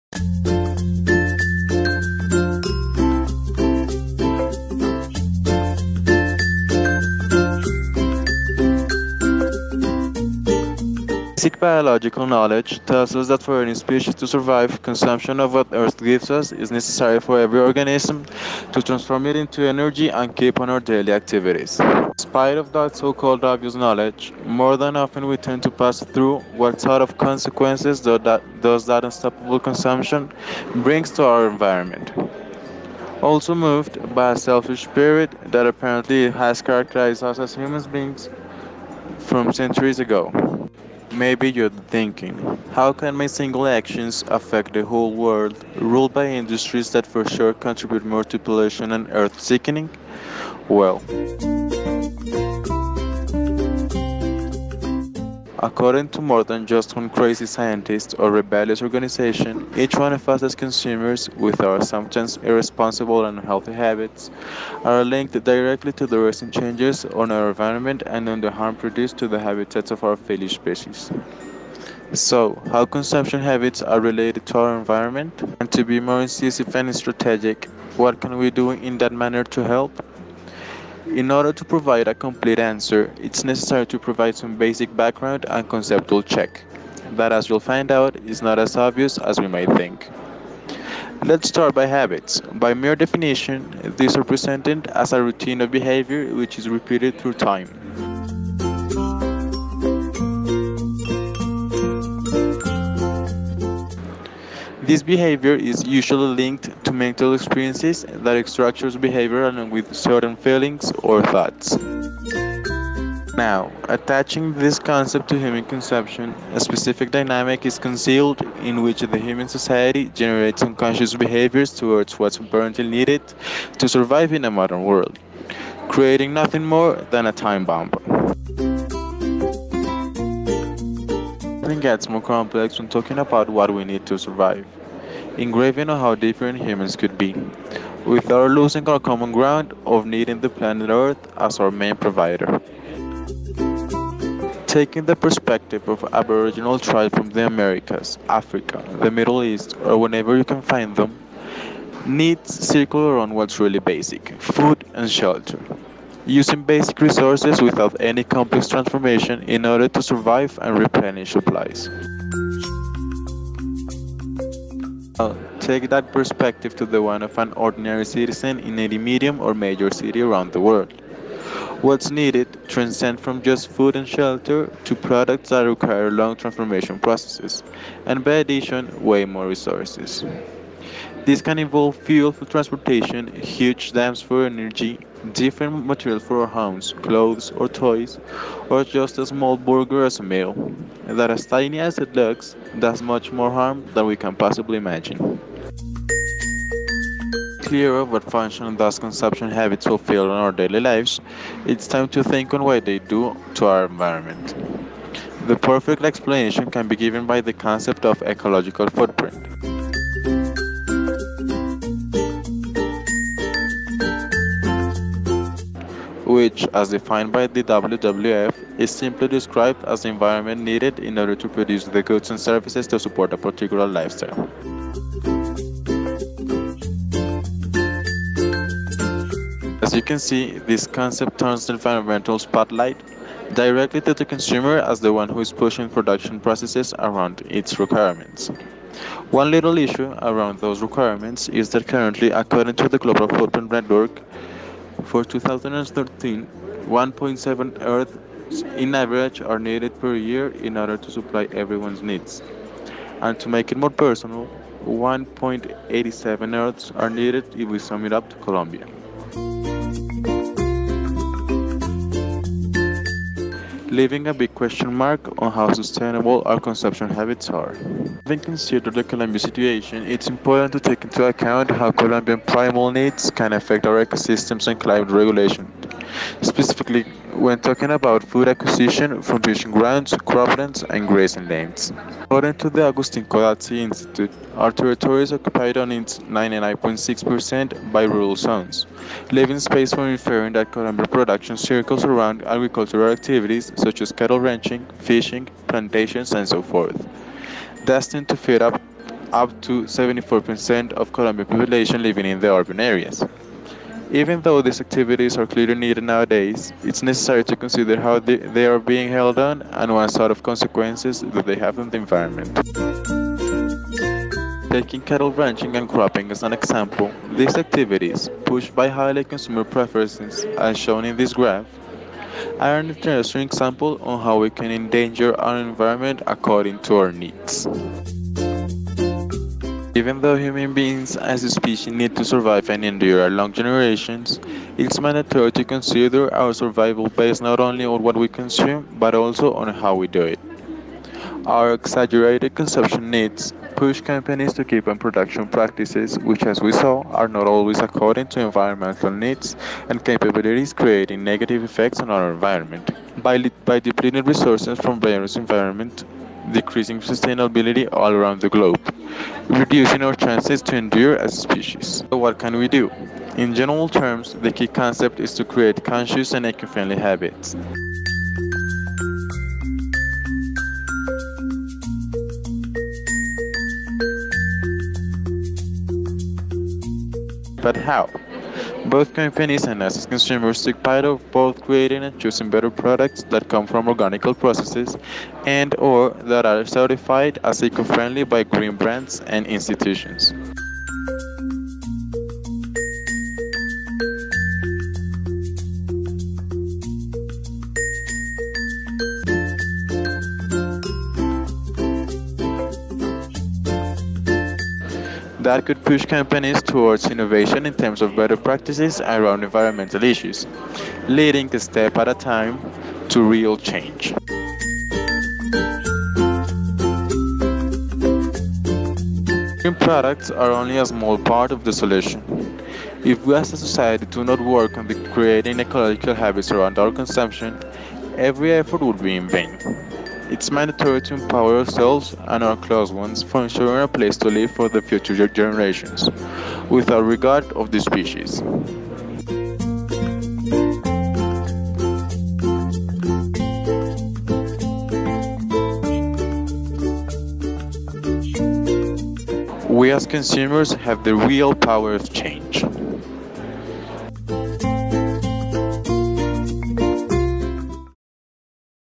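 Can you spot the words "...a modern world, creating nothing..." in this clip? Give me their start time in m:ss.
2:04.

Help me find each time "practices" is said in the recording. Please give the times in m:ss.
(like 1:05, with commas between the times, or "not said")
5:45, 6:48.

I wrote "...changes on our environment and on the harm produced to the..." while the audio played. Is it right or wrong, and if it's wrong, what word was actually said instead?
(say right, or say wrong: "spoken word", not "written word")
right.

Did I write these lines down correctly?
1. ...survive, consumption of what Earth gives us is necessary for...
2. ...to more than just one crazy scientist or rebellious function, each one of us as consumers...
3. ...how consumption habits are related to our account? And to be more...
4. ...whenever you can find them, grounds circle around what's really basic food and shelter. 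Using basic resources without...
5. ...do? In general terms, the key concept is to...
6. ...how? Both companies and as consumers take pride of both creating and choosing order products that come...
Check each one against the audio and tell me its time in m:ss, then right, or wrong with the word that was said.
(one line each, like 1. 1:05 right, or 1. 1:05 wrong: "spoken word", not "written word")
1. 0:14 right
2. 0:56 wrong: "organization", not "function"
3. 1:12 wrong: "environment", not "account"
4. 2:29 wrong: "needs", not "grounds"
5. 6:02 right
6. 6:17 wrong: "better", not "order".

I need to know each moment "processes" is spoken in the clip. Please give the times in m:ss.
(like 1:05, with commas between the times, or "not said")
2:56, 3:56, 6:24.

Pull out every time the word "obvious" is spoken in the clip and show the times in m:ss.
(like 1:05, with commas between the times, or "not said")
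0:23, 1:28.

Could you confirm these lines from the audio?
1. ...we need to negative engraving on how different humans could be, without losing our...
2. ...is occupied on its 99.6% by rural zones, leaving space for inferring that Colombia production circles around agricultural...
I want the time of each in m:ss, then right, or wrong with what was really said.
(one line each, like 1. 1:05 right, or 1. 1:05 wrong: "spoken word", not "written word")
1. 2:13 wrong: "survive", not "negative"
2. 4:45 right.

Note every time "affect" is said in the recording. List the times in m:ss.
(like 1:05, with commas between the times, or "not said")
0:44, 4:33.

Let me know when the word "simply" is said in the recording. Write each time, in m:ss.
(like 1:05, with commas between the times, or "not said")
3:38.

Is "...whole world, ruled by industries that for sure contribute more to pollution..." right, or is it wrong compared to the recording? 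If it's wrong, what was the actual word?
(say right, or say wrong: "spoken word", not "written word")
right.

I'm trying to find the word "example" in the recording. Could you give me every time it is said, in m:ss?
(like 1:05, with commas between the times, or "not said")
5:16, 5:23.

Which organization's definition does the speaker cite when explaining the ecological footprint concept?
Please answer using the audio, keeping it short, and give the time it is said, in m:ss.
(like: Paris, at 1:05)
WWF, at 3:37.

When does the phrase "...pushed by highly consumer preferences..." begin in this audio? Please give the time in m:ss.
5:18.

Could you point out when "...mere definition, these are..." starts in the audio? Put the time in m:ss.
1:32.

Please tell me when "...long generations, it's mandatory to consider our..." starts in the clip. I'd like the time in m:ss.
5:33.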